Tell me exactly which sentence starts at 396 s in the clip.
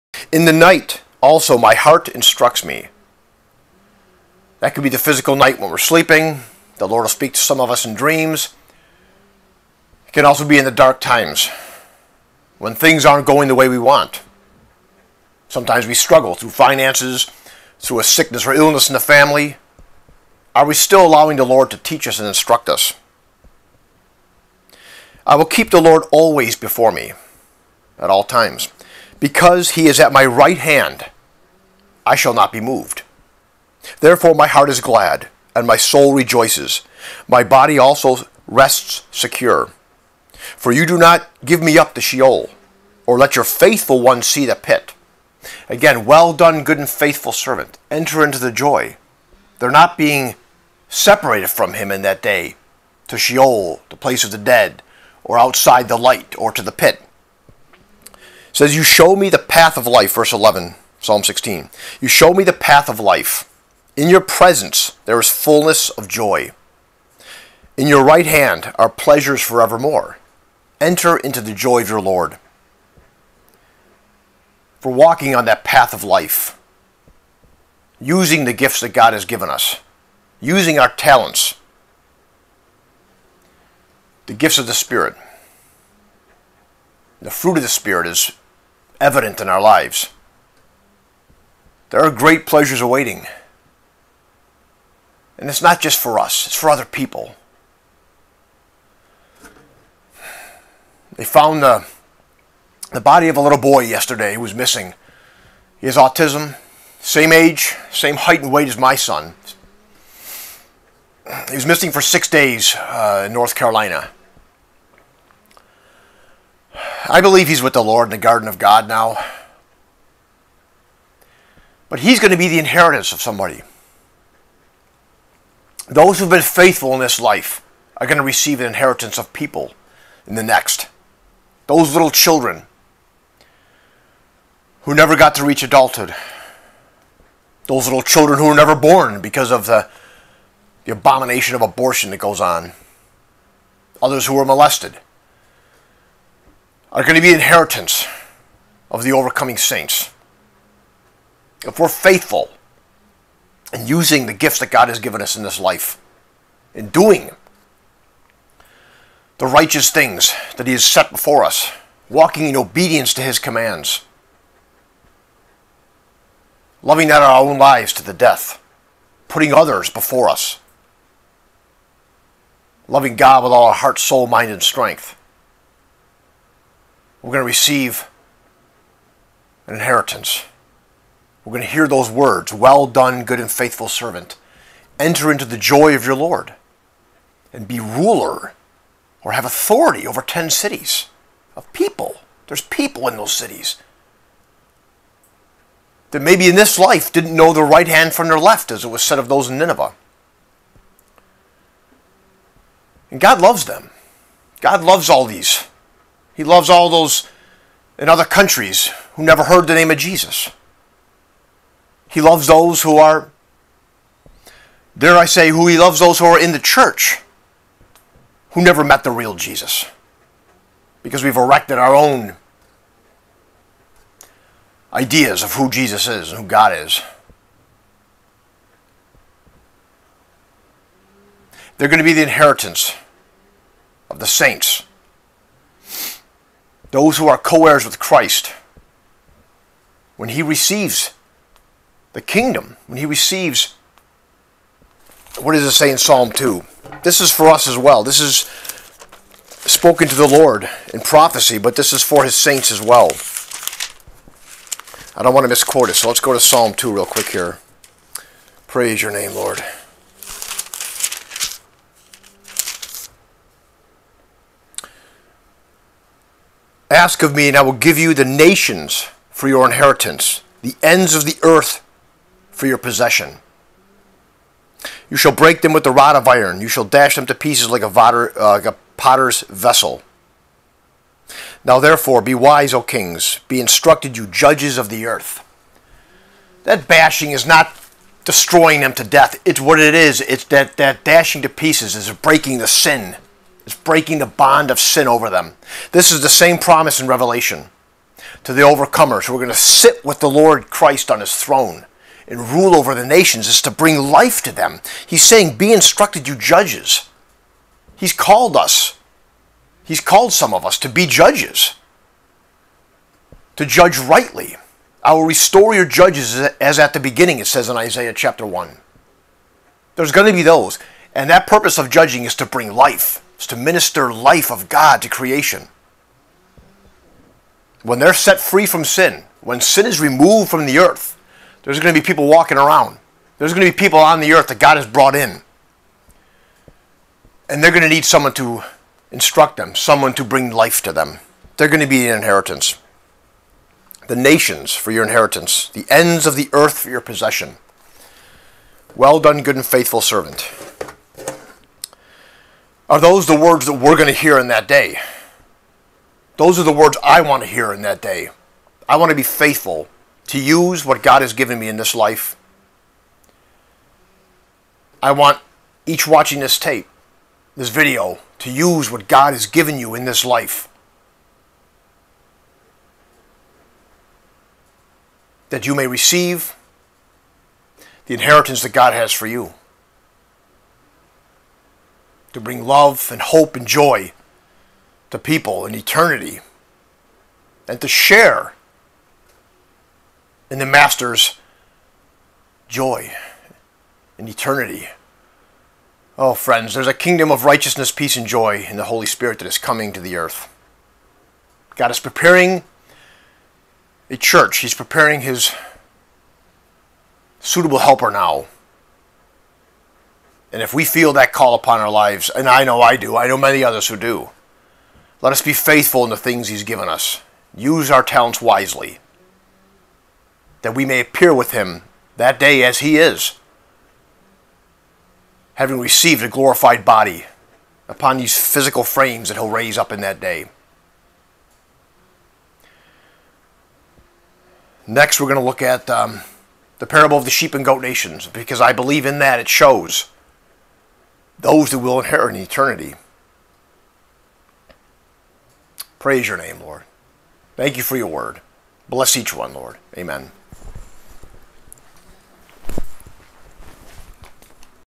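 Oh, friends, there's a kingdom of righteousness, peace, and joy in the Holy Spirit that is coming to the earth.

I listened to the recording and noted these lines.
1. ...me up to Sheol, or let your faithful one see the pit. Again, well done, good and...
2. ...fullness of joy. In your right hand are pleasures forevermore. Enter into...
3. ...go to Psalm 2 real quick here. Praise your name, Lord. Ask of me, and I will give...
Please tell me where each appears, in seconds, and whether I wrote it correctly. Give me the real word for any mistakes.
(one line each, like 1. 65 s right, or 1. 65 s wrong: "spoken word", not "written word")
1. 41 s right
2. 65 s right
3. 256 s right.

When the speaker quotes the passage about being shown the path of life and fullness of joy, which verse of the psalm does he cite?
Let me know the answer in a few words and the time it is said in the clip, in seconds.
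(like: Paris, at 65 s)
Verse 11, at 60 s.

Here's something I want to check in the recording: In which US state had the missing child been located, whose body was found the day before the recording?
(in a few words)
North Carolina.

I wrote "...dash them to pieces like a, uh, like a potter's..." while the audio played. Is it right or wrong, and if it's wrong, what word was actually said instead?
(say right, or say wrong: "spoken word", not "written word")
right.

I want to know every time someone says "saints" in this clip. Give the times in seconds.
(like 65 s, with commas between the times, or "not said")
149 s, 234 s, 252 s.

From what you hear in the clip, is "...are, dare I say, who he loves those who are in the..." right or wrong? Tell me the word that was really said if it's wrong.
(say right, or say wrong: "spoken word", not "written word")
right.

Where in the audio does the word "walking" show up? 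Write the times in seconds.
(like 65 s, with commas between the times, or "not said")
74 s, 162 s, 332 s.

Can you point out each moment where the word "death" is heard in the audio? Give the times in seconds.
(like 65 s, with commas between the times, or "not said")
168 s, 289 s.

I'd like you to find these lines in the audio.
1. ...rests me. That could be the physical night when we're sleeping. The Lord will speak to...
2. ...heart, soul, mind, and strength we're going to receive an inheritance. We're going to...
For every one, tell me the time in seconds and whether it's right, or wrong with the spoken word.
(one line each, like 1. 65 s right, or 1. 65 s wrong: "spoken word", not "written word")
1. 2 s wrong: "instructs", not "rests"
2. 173 s right.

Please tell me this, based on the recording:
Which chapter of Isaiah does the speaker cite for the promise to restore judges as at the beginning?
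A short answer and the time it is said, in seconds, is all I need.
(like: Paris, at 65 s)
Chapter 1, at 318 s.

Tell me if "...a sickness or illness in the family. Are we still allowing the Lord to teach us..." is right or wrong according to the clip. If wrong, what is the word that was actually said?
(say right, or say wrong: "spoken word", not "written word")
right.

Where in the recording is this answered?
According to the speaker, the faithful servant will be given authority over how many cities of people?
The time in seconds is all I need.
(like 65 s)
190 s.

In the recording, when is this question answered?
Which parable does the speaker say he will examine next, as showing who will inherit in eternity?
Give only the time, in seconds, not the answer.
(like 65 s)
437 s.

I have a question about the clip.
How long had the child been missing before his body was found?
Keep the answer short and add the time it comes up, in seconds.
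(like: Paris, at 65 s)
6 days, at 112 s.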